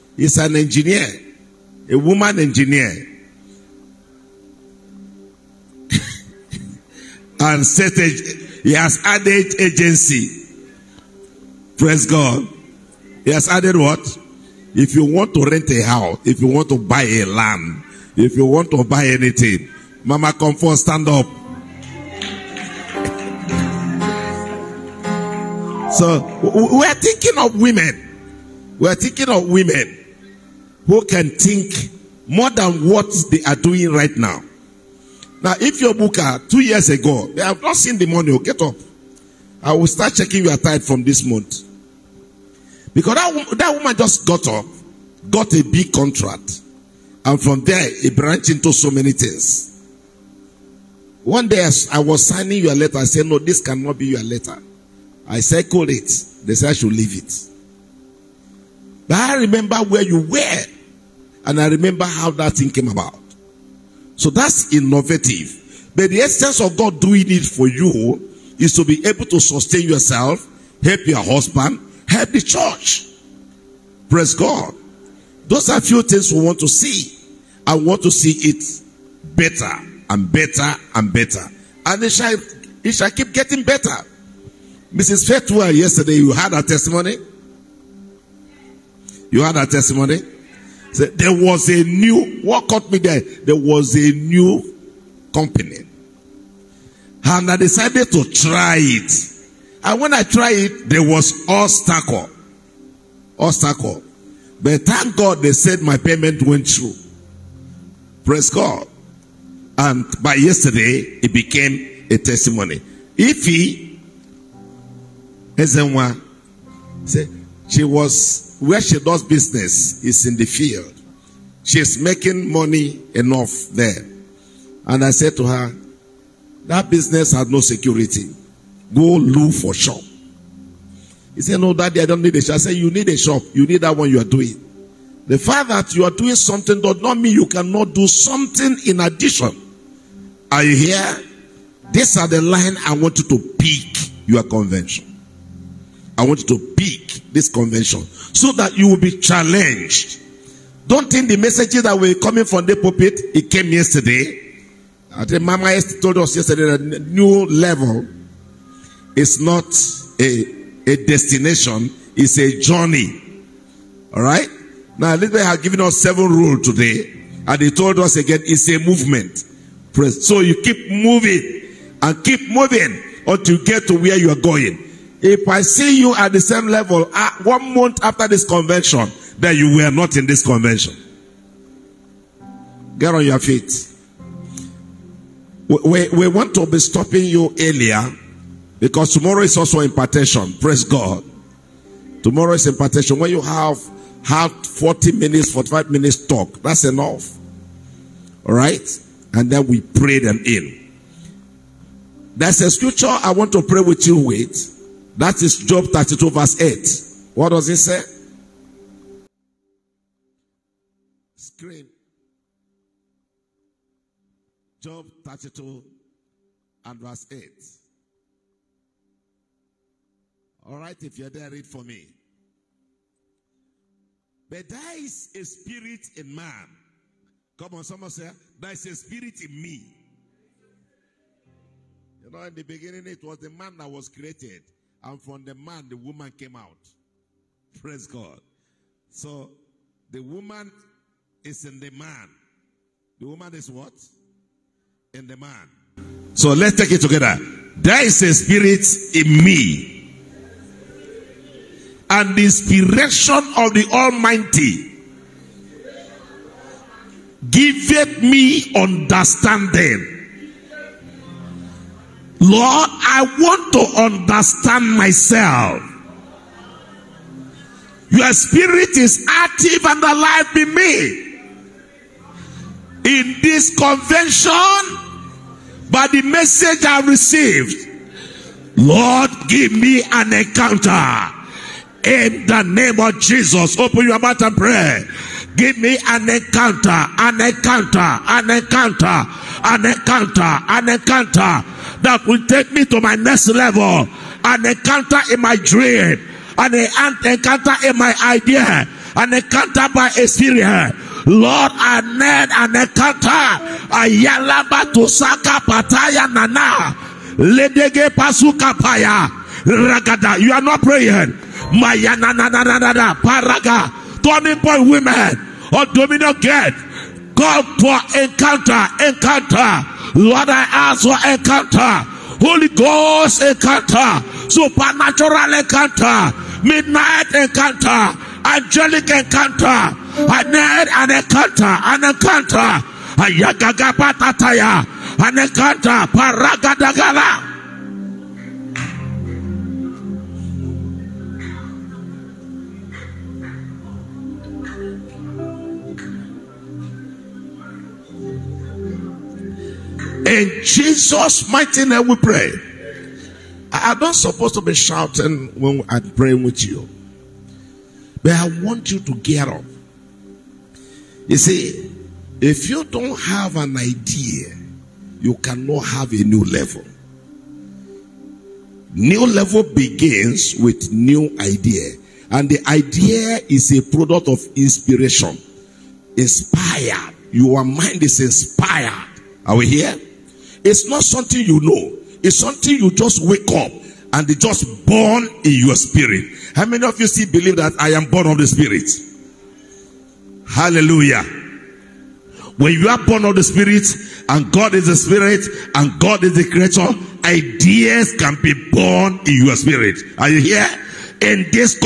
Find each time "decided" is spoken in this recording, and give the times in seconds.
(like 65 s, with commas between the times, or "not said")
97 s.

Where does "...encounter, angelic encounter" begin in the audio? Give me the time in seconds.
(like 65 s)
327 s.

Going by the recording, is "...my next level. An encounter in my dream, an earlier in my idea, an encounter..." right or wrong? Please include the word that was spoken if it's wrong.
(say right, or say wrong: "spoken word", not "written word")
wrong: "encounter", not "earlier".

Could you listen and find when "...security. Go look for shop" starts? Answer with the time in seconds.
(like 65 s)
127 s.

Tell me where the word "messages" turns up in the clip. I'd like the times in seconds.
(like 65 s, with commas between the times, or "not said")
151 s, 276 s.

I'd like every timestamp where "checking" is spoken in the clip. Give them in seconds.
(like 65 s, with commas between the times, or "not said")
40 s.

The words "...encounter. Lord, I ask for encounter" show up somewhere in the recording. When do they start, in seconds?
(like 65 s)
319 s.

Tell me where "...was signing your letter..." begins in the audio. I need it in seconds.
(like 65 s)
51 s.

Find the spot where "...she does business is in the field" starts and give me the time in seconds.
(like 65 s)
118 s.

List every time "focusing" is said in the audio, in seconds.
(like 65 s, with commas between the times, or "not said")
not said.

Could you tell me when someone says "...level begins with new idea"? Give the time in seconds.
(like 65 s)
369 s.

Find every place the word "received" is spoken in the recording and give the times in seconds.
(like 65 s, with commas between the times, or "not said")
277 s.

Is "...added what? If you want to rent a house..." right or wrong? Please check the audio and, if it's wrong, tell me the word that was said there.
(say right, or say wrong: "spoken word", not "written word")
right.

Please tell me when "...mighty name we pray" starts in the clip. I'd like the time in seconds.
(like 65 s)
351 s.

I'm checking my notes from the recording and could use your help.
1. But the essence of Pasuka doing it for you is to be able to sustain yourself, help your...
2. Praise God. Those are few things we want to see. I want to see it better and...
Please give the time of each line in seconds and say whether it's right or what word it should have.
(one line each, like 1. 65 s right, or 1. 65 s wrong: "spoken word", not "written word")
1. 65 s wrong: "God", not "Pasuka"
2. 74 s right.